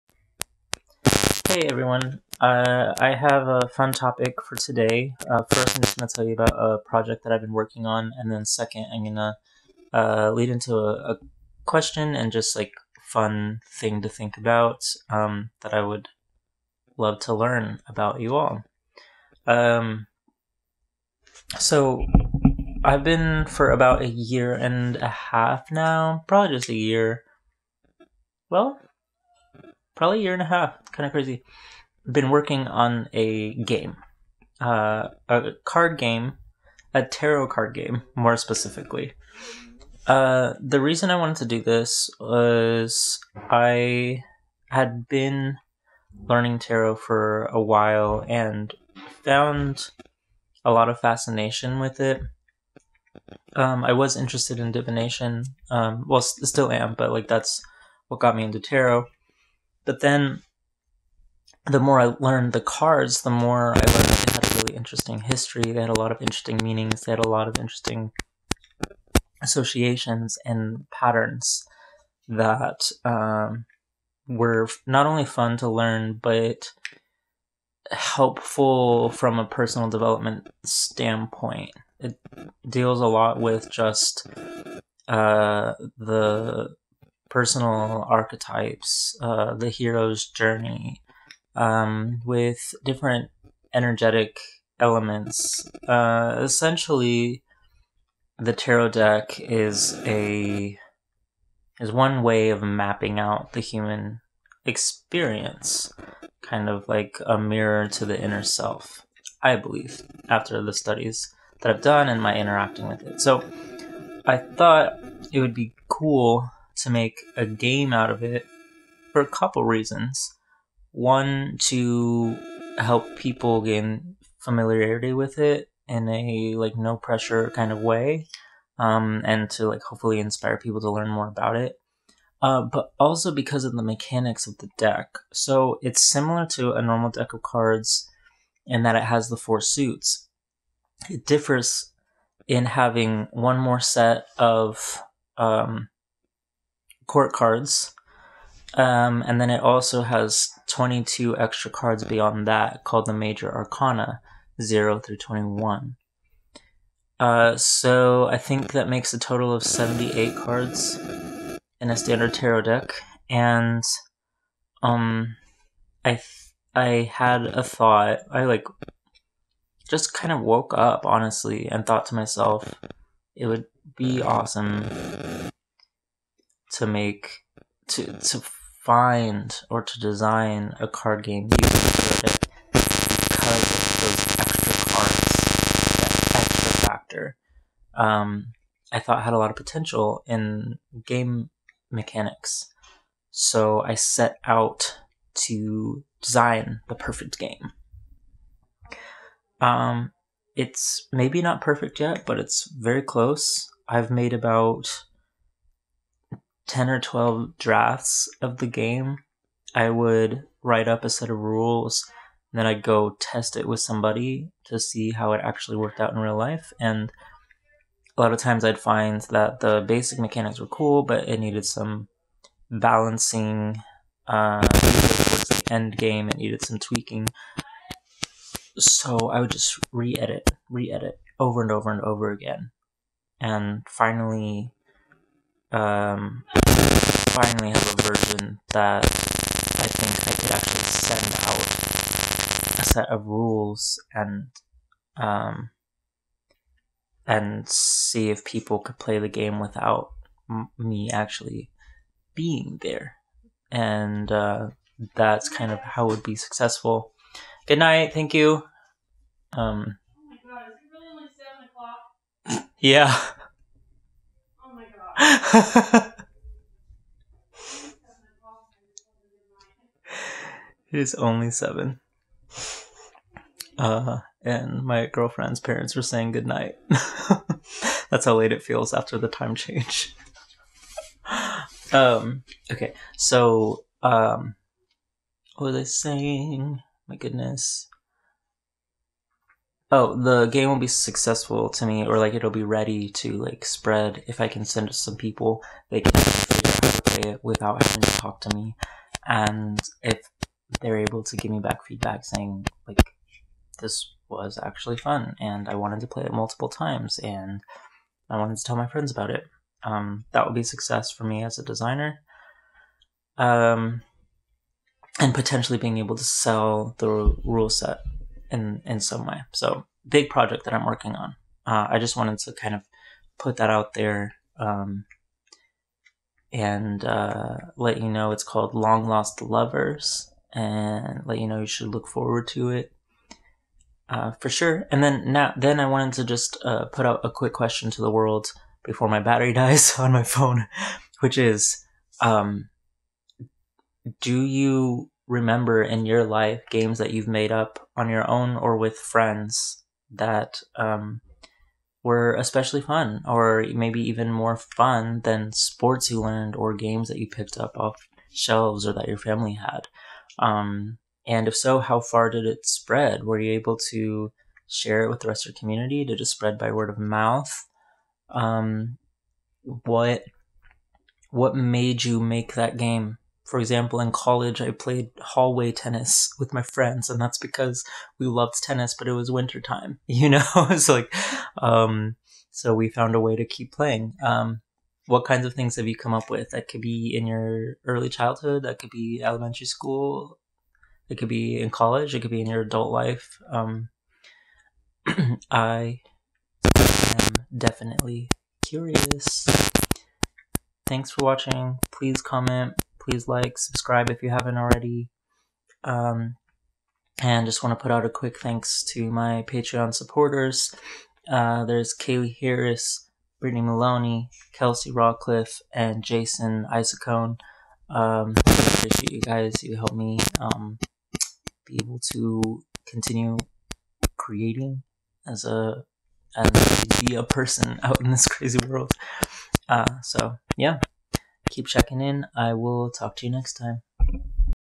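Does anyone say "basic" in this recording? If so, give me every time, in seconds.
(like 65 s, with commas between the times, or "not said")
219 s.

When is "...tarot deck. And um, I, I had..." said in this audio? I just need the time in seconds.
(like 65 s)
162 s.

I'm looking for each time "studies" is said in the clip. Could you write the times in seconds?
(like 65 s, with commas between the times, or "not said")
110 s.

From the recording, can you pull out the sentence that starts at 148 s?
Um, and then it also has 22 extra cards beyond that called the Major Arcana, 0 through 21.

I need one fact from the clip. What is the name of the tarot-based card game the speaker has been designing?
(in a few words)
Long Lost Lovers.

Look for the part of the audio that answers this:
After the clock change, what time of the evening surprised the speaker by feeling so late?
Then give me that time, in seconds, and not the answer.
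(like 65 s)
261 s.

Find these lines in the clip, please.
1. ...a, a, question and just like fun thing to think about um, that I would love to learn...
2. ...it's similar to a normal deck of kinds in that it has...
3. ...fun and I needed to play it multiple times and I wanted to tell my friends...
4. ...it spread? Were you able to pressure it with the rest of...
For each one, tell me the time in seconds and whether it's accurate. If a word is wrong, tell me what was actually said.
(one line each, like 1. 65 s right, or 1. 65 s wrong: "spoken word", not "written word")
1. 10 s right
2. 135 s wrong: "cards", not "kinds"
3. 304 s wrong: "wanted", not "needed"
4. 362 s wrong: "share", not "pressure".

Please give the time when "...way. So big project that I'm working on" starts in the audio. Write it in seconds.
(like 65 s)
319 s.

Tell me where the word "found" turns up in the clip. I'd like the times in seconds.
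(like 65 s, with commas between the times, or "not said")
49 s, 382 s.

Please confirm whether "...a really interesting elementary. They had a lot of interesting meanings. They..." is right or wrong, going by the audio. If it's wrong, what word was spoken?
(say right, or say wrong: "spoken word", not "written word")
wrong: "history", not "elementary".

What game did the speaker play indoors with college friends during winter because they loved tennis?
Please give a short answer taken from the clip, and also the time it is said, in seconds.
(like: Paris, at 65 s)
Hallway tennis, at 375 s.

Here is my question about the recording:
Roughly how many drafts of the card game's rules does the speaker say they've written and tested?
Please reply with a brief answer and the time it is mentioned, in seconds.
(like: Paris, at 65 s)
10 or 12, at 206 s.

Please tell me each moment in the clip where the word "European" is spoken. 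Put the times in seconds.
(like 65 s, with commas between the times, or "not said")
not said.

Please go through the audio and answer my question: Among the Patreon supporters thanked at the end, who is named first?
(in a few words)
Kaylee Harris.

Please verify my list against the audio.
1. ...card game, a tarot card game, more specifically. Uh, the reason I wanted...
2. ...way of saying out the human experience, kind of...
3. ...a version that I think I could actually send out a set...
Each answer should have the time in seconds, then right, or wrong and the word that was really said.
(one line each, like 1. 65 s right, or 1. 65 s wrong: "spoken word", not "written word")
1. 35 s right
2. 102 s wrong: "mapping", not "saying"
3. 237 s right.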